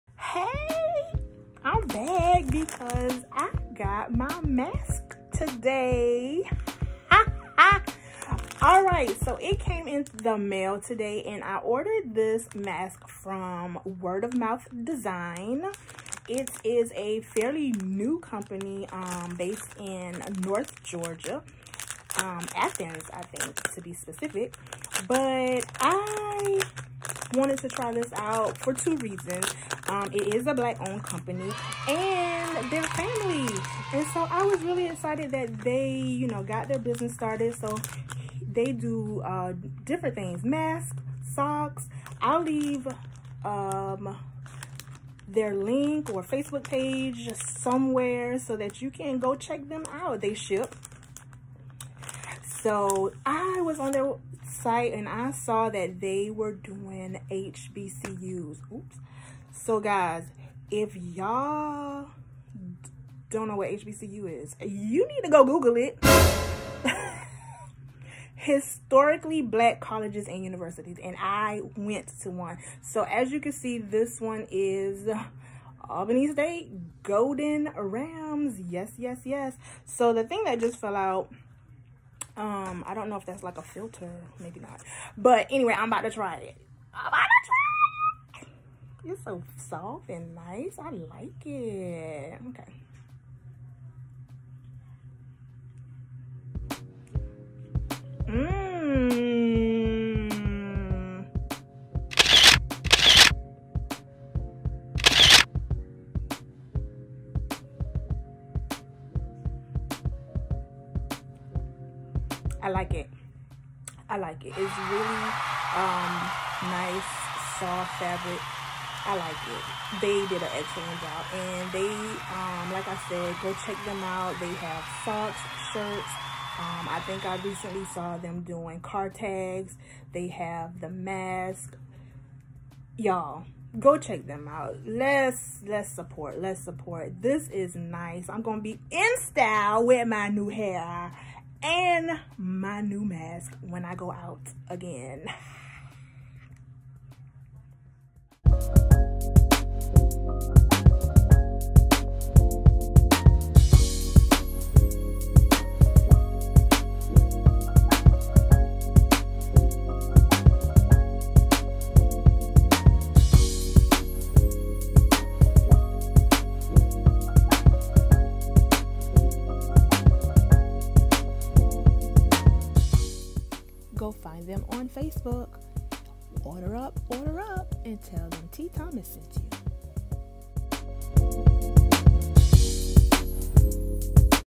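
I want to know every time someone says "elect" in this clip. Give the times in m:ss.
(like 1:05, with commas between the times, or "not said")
not said.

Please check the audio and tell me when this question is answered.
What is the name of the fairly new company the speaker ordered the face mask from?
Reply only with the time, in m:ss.
0:13.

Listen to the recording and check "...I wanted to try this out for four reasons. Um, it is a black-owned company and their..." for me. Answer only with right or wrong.
wrong.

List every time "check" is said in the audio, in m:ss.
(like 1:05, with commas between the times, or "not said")
0:49, 2:03, 2:13.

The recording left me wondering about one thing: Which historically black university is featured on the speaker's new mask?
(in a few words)
Albany State.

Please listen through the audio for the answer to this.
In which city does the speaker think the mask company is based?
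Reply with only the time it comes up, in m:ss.
0:22.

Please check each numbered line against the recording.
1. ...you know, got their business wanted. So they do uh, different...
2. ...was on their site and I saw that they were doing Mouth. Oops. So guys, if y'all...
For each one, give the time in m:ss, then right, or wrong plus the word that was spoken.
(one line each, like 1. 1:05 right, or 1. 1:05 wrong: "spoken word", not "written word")
1. 0:35 wrong: "started", not "wanted"
2. 0:53 wrong: "HBCUs", not "Mouth".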